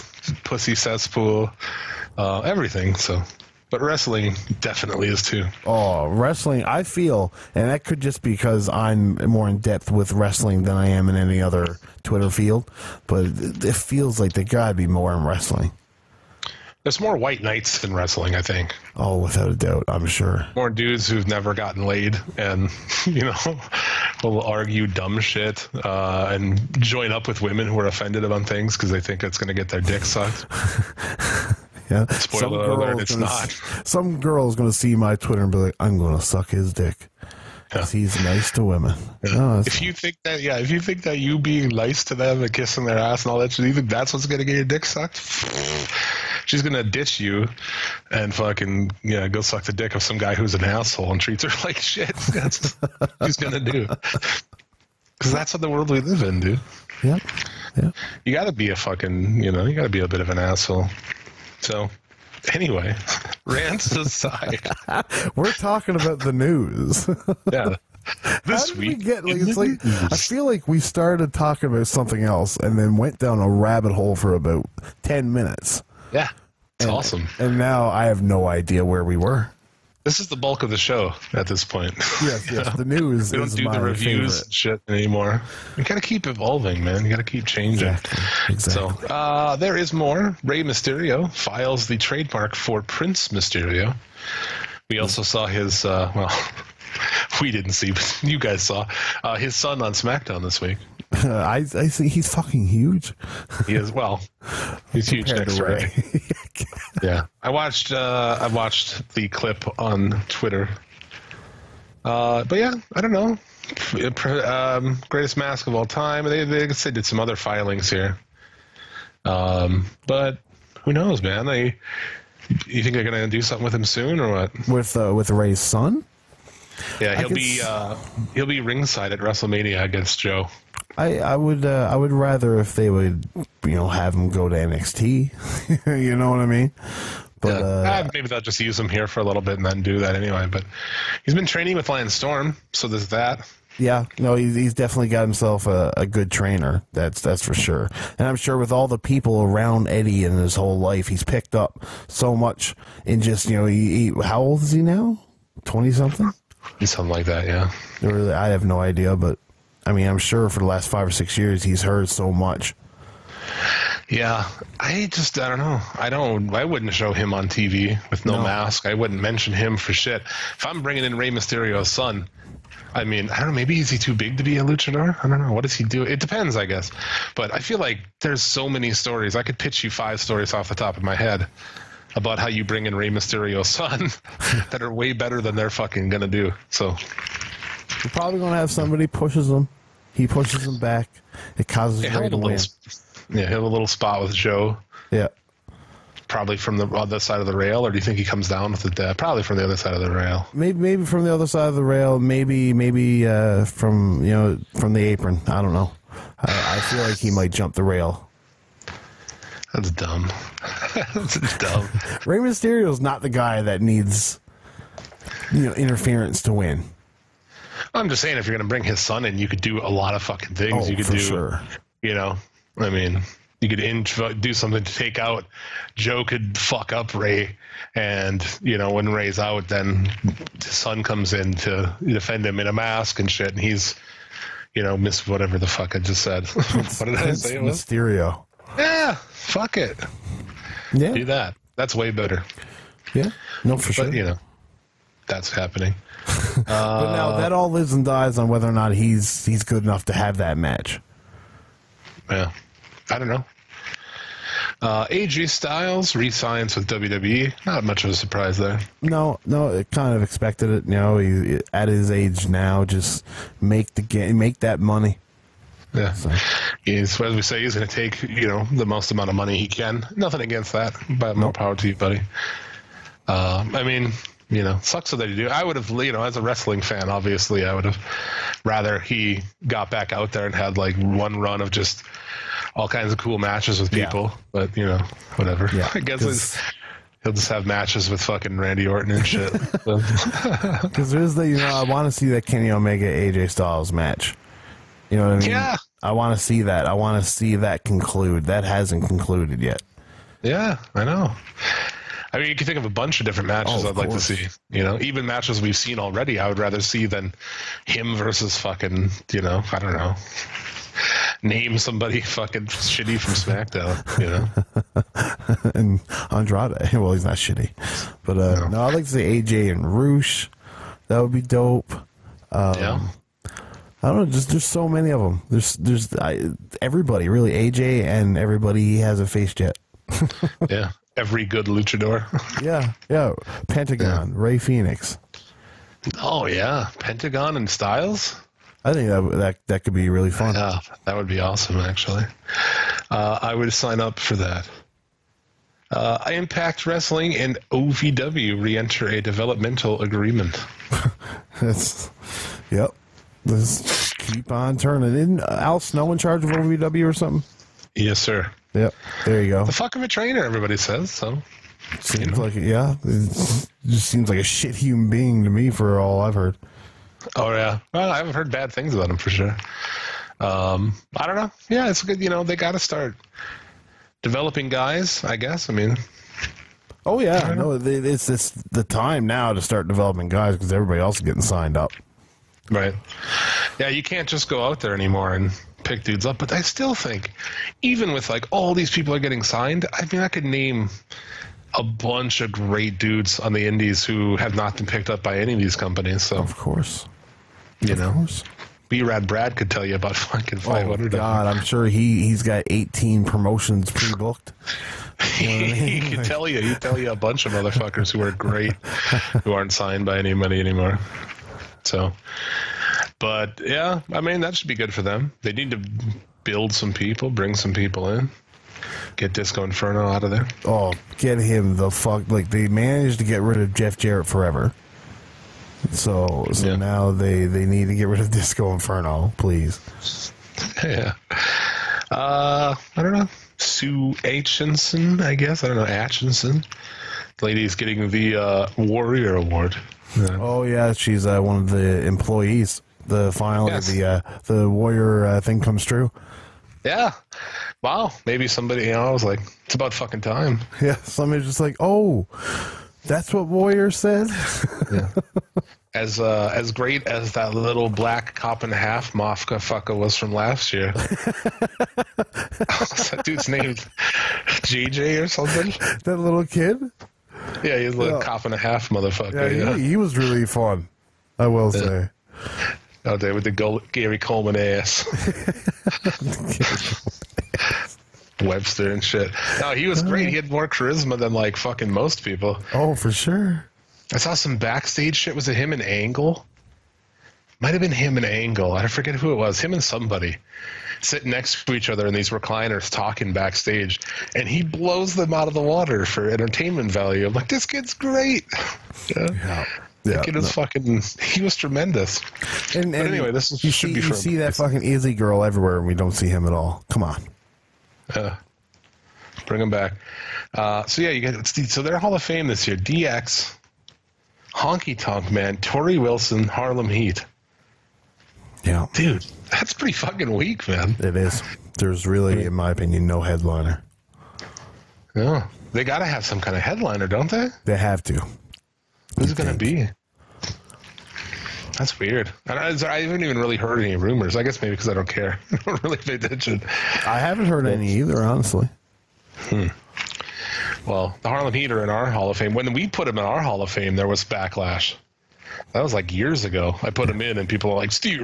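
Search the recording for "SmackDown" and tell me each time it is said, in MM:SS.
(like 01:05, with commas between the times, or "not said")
01:39, 05:13.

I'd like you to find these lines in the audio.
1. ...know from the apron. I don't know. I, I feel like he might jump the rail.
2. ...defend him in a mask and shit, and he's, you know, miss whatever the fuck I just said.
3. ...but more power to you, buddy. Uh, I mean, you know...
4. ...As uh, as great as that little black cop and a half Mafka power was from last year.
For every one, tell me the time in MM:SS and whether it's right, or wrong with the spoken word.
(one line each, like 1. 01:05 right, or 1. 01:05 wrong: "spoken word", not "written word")
1. 03:24 right
2. 03:52 right
3. 04:31 right
4. 07:35 wrong: "fucker", not "power".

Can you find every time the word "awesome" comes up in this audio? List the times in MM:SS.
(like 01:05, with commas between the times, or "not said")
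01:16, 05:41.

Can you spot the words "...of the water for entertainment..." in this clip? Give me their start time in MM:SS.
08:15.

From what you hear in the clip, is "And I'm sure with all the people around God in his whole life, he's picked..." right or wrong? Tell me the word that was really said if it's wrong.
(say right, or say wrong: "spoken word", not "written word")
wrong: "Eddie", not "God".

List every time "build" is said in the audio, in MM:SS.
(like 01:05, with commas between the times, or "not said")
06:56.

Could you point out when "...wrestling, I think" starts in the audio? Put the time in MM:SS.
00:17.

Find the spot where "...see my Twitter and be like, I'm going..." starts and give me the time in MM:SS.
00:34.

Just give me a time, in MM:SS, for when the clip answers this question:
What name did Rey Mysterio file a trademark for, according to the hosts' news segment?
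01:32.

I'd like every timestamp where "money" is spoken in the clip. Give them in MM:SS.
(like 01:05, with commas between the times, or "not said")
04:24, 04:29.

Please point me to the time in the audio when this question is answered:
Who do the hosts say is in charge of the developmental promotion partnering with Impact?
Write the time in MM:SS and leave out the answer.
05:55.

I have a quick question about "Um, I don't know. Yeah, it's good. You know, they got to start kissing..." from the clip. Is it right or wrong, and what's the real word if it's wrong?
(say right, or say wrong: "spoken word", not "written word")
wrong: "developing", not "kissing".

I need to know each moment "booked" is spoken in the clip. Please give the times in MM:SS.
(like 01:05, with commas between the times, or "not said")
06:43.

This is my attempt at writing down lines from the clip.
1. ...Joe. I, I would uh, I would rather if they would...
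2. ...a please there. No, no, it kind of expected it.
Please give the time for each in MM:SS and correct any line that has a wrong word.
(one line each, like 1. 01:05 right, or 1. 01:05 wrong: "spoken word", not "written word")
1. 02:10 right
2. 04:18 wrong: "surprise", not "please".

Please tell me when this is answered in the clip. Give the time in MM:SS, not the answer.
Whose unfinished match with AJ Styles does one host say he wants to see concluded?
04:52.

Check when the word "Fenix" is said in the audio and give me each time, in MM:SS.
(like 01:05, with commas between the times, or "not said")
05:34.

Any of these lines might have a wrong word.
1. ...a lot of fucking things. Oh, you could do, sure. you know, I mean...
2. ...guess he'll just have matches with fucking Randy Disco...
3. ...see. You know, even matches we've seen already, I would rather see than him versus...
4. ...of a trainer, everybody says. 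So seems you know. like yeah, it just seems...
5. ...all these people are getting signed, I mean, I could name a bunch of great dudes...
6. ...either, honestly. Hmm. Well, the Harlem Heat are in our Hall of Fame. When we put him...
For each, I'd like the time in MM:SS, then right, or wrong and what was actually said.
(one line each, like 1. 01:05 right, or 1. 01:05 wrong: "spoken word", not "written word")
1. 03:39 right
2. 04:46 wrong: "Orton", not "Disco"
3. 05:04 right
4. 05:59 right
5. 06:28 right
6. 08:57 right.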